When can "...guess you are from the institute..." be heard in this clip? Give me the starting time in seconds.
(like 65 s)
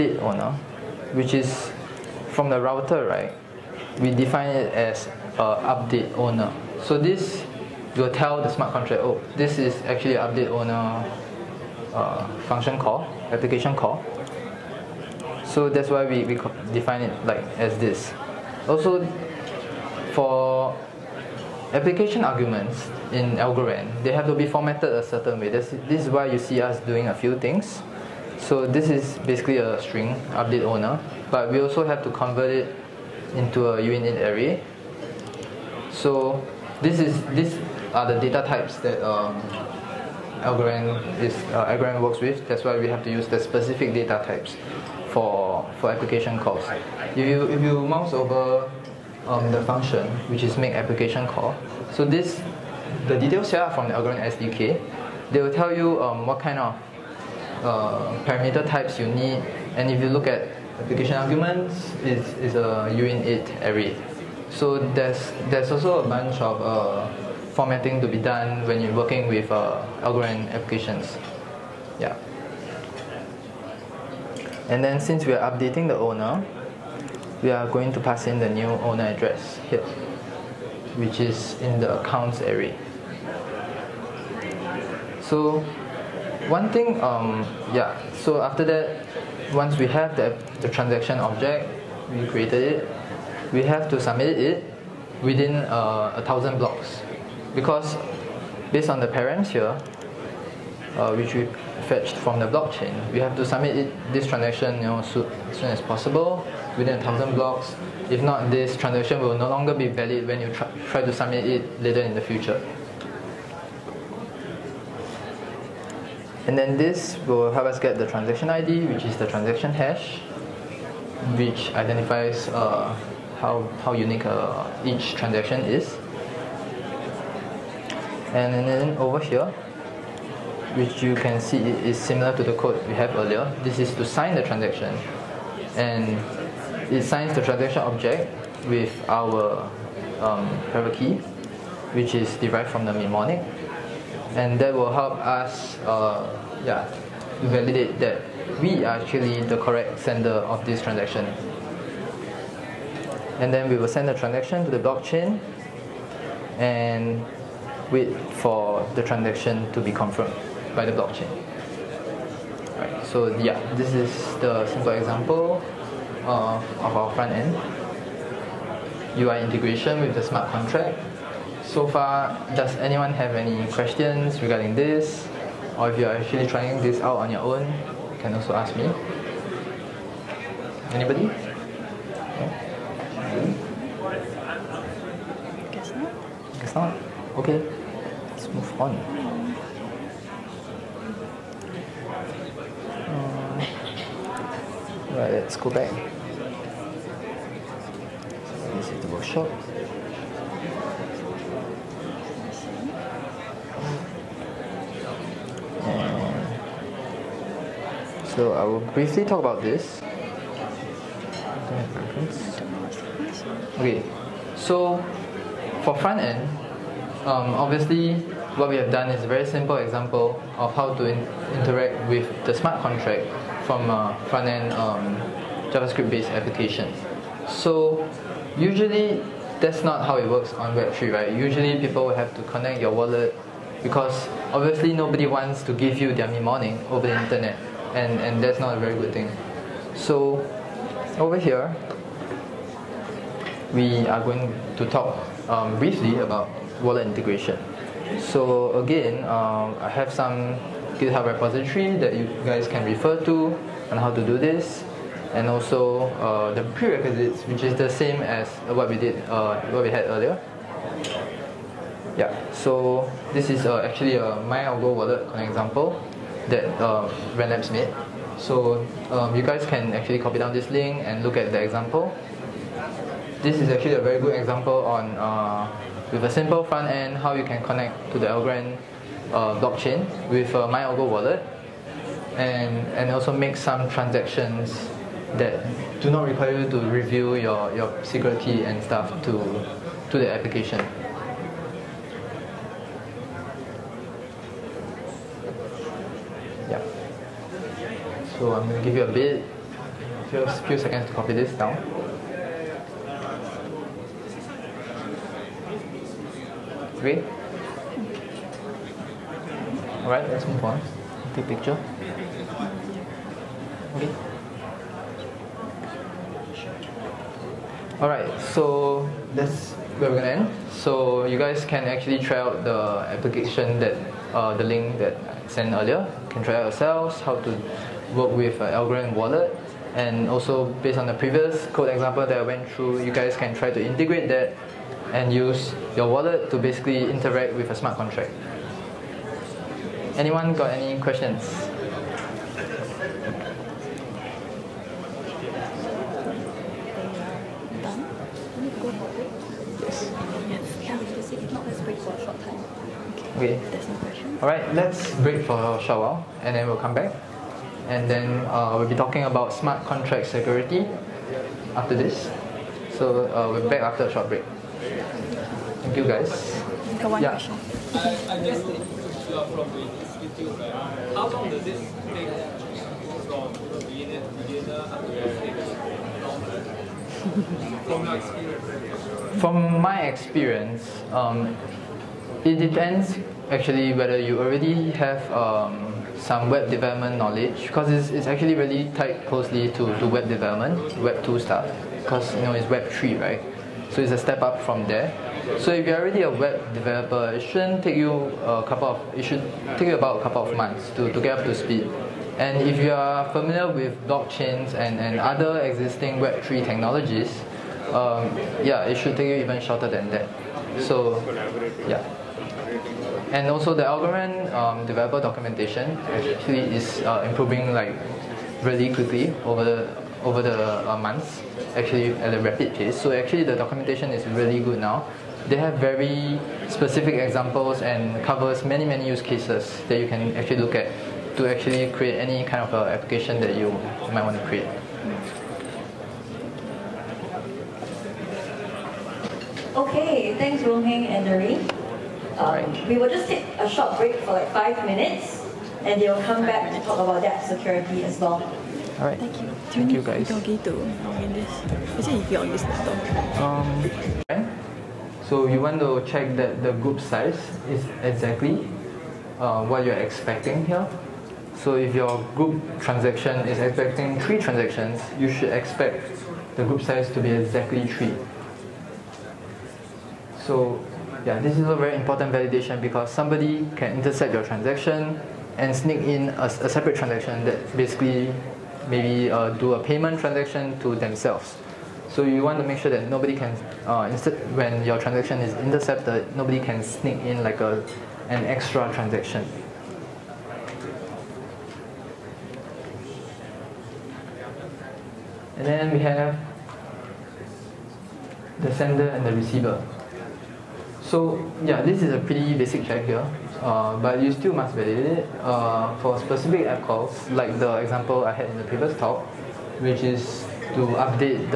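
368 s.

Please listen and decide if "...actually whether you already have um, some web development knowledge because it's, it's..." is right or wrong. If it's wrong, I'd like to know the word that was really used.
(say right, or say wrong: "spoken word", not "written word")
right.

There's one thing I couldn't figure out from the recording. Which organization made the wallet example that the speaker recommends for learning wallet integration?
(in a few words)
Rand Labs.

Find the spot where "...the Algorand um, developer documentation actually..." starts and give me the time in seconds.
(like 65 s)
413 s.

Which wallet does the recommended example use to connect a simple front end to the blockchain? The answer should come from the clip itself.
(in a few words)
MyAlgo wallet.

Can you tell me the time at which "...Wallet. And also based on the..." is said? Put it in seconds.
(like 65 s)
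329 s.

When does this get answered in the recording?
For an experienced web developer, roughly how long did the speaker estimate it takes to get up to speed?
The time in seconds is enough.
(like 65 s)
400 s.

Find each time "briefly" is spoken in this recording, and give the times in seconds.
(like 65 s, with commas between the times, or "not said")
208 s, 245 s.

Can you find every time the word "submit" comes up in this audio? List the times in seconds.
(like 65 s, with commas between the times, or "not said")
94 s, 103 s, 111 s.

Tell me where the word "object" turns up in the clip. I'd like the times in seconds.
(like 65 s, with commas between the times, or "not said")
91 s, 137 s.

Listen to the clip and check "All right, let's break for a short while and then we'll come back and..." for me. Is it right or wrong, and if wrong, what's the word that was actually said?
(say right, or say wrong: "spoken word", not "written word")
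right.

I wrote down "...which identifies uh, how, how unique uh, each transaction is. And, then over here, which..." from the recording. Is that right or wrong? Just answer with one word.
right.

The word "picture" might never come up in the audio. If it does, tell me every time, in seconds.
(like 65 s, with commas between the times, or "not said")
311 s.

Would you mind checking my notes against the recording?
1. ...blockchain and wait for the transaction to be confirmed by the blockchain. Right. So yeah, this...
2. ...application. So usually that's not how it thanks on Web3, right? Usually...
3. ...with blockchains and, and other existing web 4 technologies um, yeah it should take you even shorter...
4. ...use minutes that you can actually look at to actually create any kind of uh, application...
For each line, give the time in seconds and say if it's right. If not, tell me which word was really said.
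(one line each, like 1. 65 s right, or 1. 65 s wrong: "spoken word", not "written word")
1. 154 s right
2. 226 s wrong: "works", not "thanks"
3. 403 s wrong: "3", not "4"
4. 429 s wrong: "cases", not "minutes".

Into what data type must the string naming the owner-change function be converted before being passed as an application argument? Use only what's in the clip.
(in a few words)
Uint8 array.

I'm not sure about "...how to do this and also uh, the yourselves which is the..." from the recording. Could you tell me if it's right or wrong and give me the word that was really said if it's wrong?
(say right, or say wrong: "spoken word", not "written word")
wrong: "prerequisites", not "yourselves".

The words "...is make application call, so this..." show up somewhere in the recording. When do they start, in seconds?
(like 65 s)
50 s.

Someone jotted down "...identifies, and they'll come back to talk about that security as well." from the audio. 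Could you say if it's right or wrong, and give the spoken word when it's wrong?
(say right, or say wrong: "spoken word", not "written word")
wrong: "minutes", not "identifies".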